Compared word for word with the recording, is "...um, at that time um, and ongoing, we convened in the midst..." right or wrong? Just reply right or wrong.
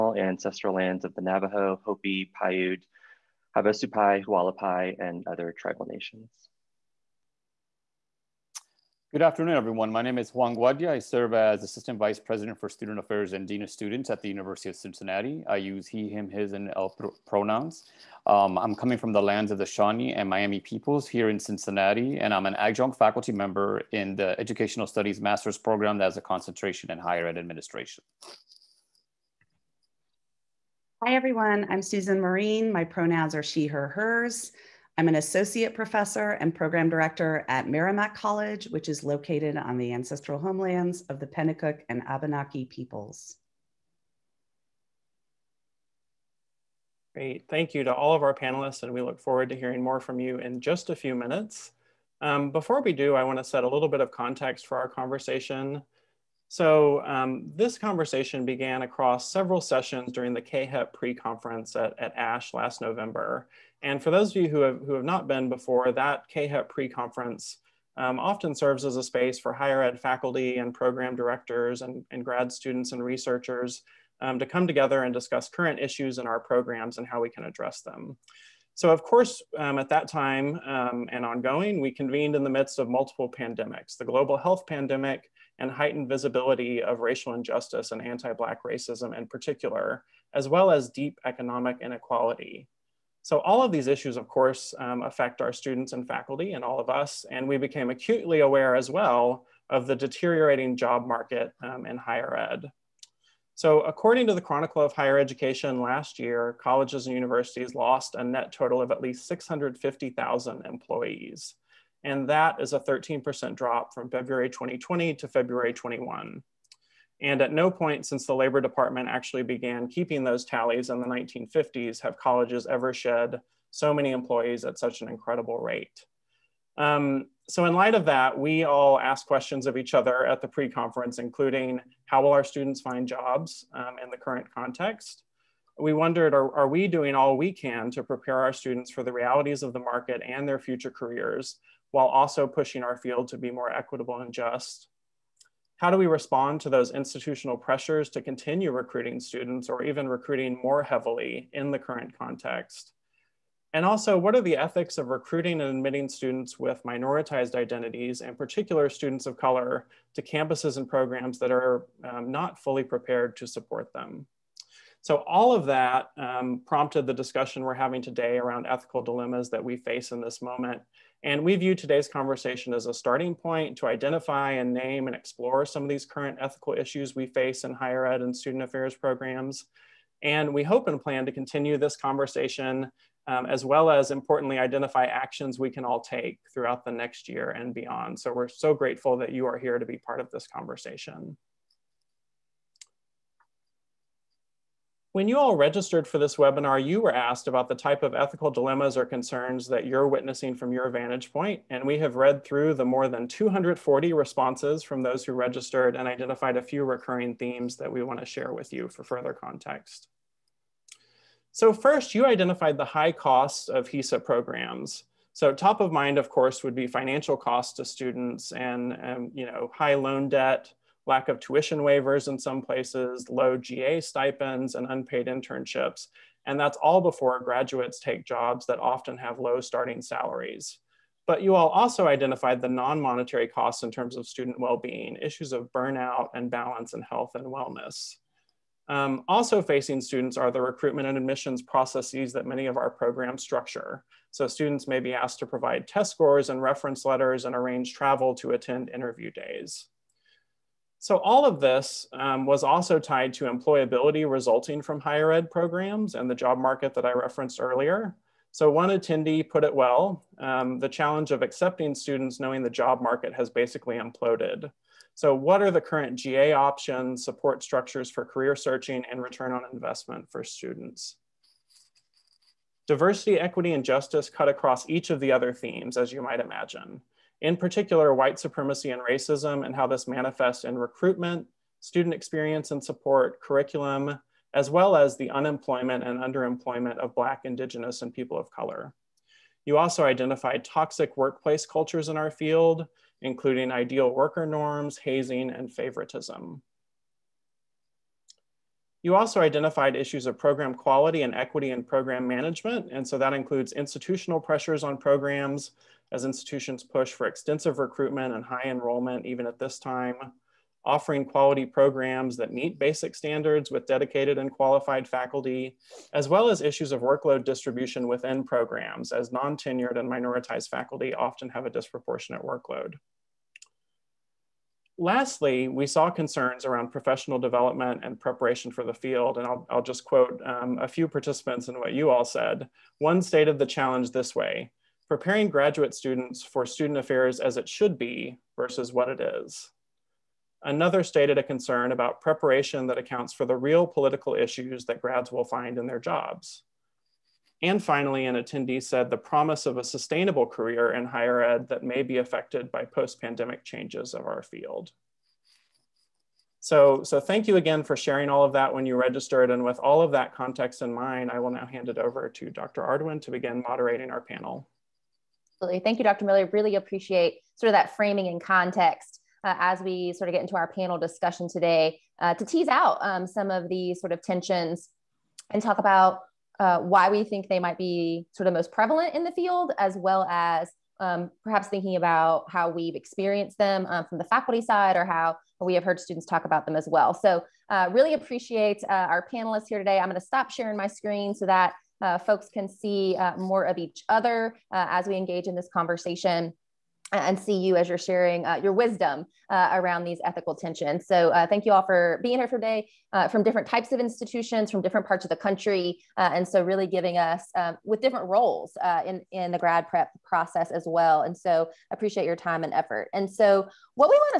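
right.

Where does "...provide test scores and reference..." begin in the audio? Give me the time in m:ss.
4:05.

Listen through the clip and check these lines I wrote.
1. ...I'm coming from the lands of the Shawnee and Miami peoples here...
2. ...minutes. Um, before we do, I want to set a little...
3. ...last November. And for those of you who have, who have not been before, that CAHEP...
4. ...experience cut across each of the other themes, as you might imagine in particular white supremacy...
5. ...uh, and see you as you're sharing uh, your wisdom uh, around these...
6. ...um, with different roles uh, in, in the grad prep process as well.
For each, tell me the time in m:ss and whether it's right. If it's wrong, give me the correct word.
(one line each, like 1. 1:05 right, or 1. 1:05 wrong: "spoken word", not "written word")
1. 0:18 right
2. 0:51 right
3. 1:02 right
4. 4:33 wrong: "justice", not "experience"
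5. 6:37 right
6. 6:47 right.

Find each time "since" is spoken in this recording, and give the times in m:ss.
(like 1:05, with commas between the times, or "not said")
1:58.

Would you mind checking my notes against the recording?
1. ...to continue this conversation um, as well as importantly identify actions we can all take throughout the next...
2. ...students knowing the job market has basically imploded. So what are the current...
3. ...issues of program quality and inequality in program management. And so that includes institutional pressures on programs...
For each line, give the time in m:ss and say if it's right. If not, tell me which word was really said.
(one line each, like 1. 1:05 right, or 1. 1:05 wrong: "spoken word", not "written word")
1. 3:01 right
2. 4:21 right
3. 4:59 wrong: "equity", not "inequality".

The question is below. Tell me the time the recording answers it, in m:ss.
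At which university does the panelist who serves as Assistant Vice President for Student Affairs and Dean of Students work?
0:14.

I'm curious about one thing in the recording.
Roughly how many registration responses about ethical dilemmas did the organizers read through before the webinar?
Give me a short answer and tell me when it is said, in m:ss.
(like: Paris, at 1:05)
240, at 3:23.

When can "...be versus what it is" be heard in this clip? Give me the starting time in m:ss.
5:37.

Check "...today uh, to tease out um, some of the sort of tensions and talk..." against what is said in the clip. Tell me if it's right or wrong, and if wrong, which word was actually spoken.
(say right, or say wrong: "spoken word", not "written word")
right.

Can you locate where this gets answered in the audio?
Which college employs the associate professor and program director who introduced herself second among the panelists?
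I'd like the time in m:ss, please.
0:37.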